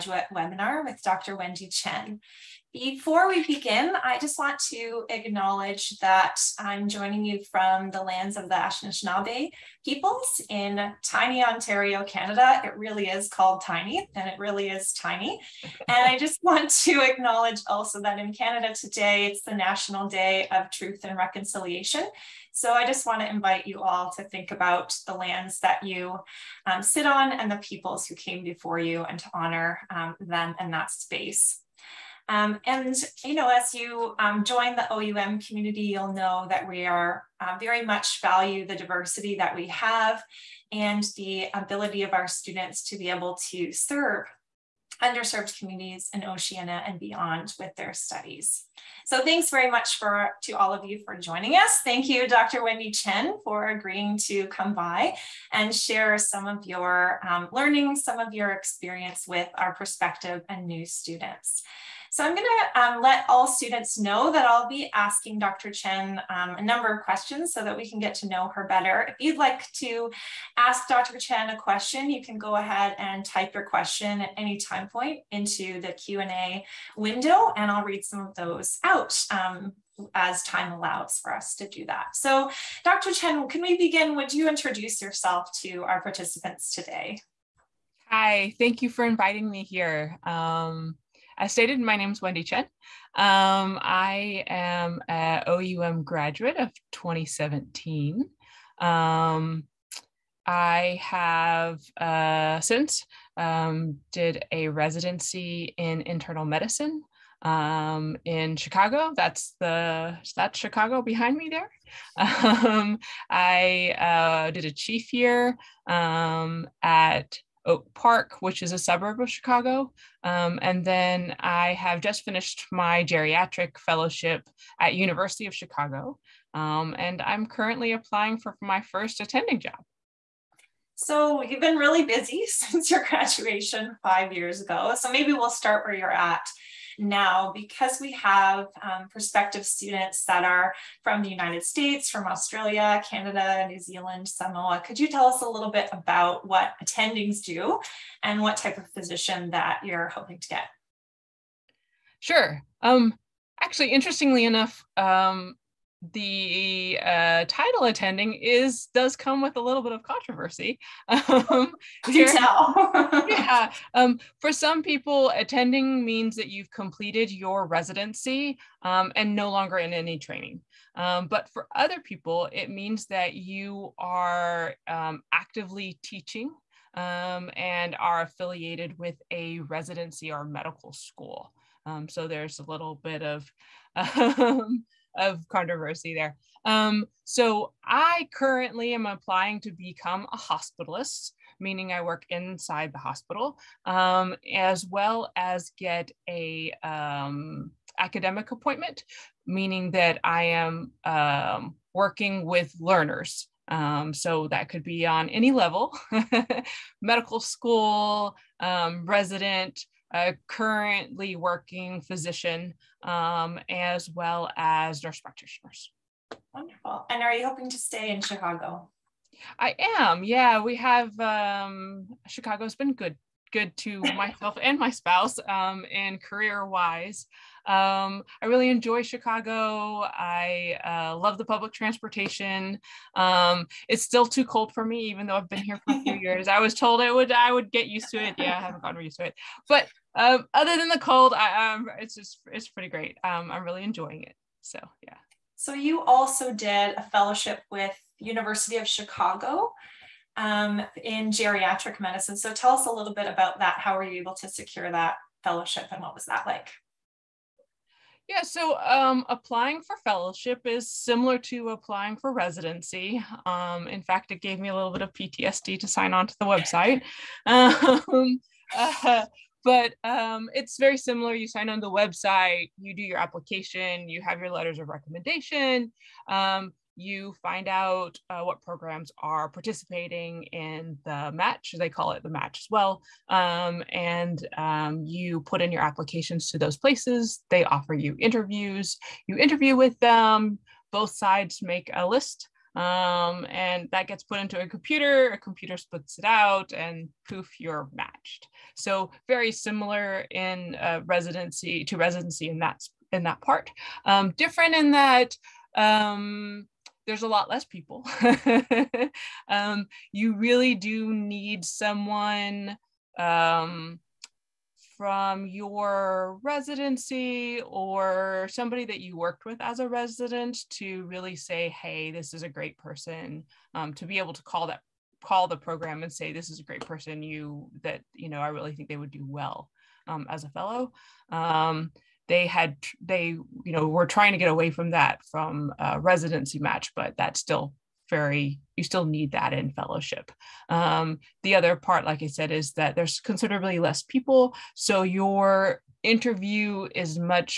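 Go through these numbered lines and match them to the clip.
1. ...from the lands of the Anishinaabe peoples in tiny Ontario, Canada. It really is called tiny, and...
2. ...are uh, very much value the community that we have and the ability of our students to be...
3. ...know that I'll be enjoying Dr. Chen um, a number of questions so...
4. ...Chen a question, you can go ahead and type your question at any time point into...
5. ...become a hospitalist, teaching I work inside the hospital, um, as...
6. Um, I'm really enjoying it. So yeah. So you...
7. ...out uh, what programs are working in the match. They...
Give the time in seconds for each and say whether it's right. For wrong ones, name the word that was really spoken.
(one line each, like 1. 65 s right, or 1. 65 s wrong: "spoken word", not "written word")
1. 7 s right
2. 36 s wrong: "diversity", not "community"
3. 63 s wrong: "asking", not "enjoying"
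4. 71 s right
5. 189 s wrong: "meaning", not "teaching"
6. 243 s right
7. 277 s wrong: "participating", not "working".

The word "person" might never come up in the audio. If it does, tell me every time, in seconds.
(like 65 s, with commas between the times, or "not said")
322 s, 326 s.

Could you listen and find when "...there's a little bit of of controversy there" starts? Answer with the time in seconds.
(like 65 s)
182 s.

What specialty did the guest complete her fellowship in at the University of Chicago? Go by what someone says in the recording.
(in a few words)
Geriatric medicine.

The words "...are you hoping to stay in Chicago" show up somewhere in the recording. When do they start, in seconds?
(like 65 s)
217 s.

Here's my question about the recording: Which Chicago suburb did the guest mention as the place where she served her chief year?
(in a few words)
Oak Park.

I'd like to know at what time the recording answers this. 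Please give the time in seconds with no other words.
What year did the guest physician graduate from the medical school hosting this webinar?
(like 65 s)
96 s.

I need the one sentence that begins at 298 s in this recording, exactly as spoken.
So very similar in uh, residency to residency in that in that part.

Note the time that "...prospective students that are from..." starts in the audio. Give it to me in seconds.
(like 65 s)
139 s.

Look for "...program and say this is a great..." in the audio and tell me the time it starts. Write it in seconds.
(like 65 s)
325 s.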